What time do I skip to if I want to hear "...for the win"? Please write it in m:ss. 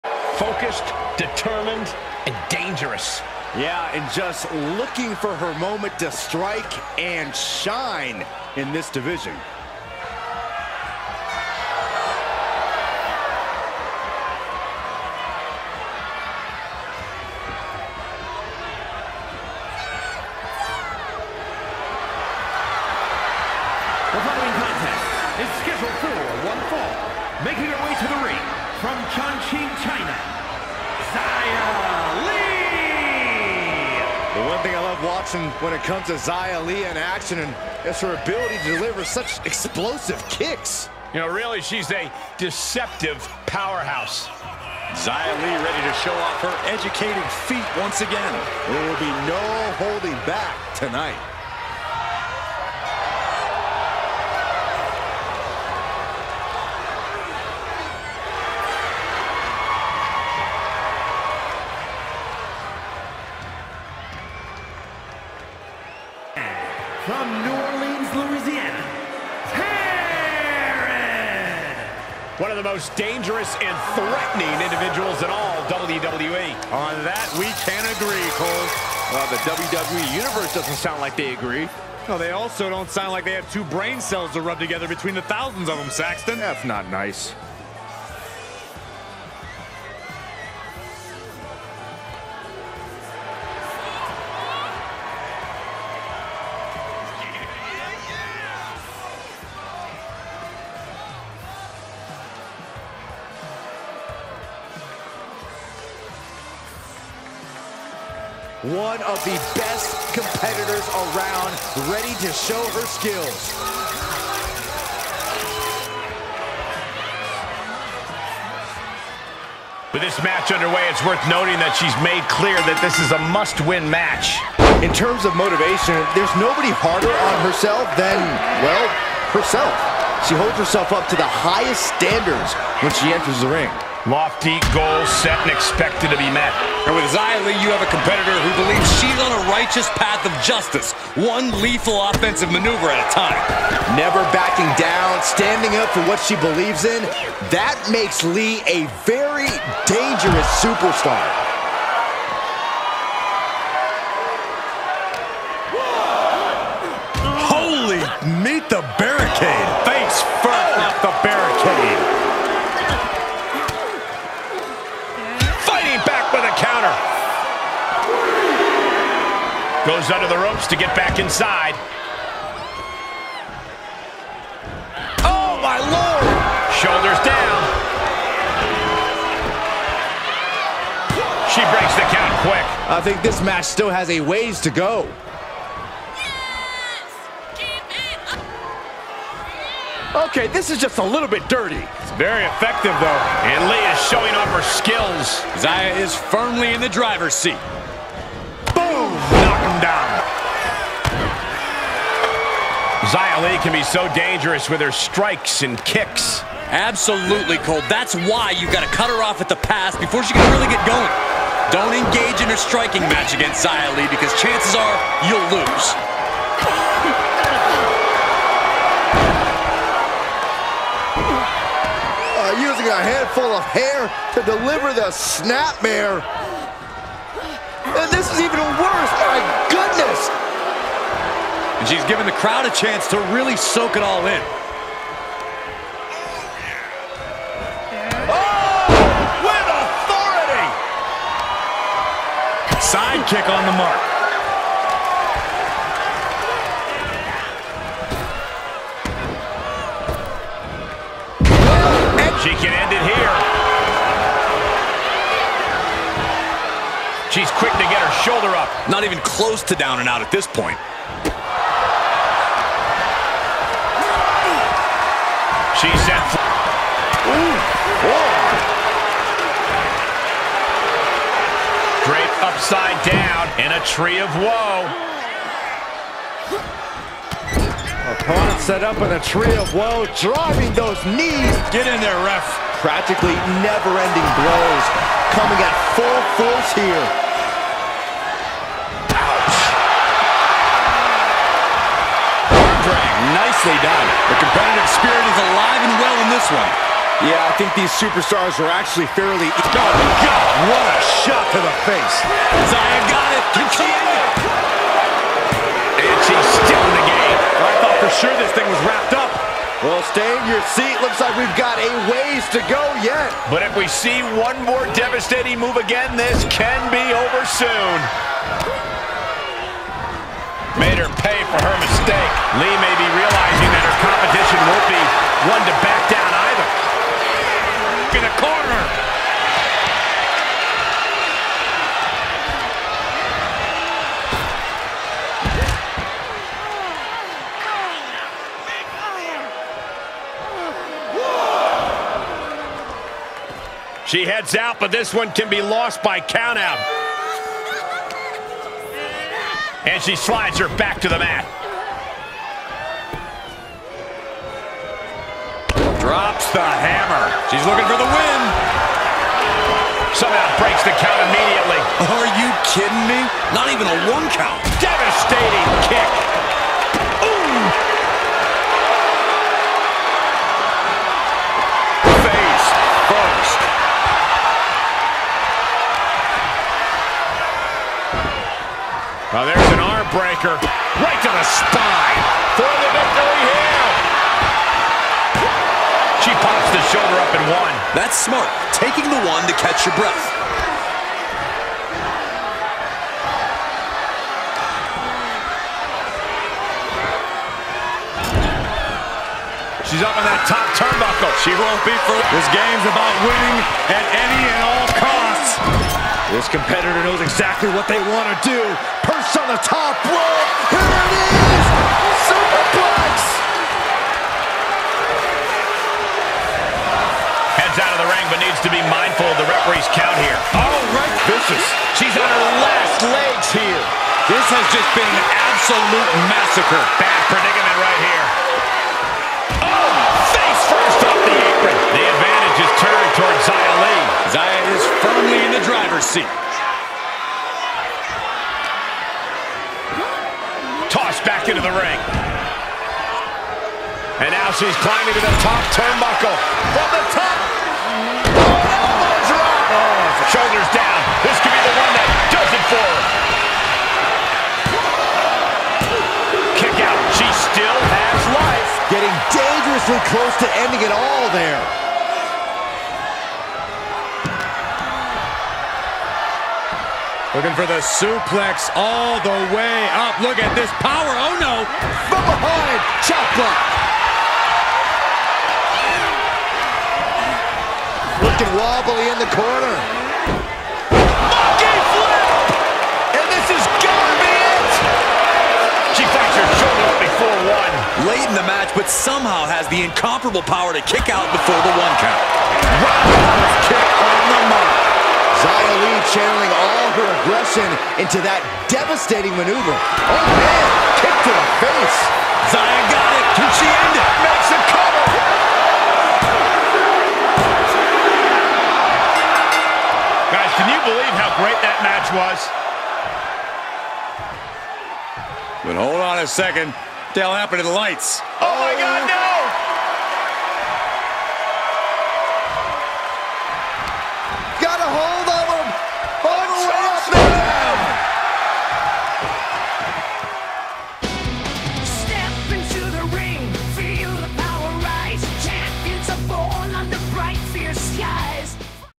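5:57.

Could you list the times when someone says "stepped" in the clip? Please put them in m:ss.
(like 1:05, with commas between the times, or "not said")
not said.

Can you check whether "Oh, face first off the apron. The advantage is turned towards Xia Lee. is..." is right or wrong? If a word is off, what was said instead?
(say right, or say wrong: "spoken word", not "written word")
right.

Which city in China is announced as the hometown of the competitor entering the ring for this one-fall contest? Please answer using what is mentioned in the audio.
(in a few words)
Chongqing.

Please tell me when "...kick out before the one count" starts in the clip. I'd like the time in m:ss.
8:10.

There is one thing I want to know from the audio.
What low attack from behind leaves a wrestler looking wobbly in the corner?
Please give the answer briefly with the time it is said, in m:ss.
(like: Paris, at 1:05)
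Chop block, at 7:53.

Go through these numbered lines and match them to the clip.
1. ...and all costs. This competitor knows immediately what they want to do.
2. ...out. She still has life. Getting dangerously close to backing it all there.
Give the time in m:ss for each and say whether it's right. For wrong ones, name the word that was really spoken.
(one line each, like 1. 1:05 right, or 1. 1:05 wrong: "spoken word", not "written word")
1. 6:44 wrong: "exactly", not "immediately"
2. 7:36 wrong: "ending", not "backing".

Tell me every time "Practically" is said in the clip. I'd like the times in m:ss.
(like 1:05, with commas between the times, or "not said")
4:42.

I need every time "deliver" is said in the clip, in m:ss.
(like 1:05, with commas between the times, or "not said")
0:38, 3:44.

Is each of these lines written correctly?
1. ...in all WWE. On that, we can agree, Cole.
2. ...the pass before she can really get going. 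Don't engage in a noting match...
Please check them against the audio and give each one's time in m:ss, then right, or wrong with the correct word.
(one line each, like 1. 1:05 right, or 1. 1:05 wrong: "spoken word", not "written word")
1. 1:15 right
2. 3:29 wrong: "striking", not "noting".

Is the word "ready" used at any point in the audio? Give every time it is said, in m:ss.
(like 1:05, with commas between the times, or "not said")
0:45, 1:51.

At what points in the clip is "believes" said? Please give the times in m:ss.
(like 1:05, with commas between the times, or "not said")
2:18, 2:26, 8:30.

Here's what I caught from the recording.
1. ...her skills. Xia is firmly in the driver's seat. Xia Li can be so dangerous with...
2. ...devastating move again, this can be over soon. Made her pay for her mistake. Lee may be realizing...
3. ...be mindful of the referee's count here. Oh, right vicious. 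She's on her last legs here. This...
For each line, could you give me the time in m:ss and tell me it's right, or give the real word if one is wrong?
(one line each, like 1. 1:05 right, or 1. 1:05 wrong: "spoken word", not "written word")
1. 3:14 right
2. 5:14 right
3. 6:58 right.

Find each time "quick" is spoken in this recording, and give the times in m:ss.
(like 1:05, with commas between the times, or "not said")
3:02, 4:17.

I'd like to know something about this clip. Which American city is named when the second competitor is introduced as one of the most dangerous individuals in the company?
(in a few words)
New Orleans.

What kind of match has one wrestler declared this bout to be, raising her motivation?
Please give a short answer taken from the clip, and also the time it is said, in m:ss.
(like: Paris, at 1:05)
must-win match, at 2:03.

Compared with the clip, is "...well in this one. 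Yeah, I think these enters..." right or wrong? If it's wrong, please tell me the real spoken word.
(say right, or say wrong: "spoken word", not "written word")
wrong: "superstars", not "enters".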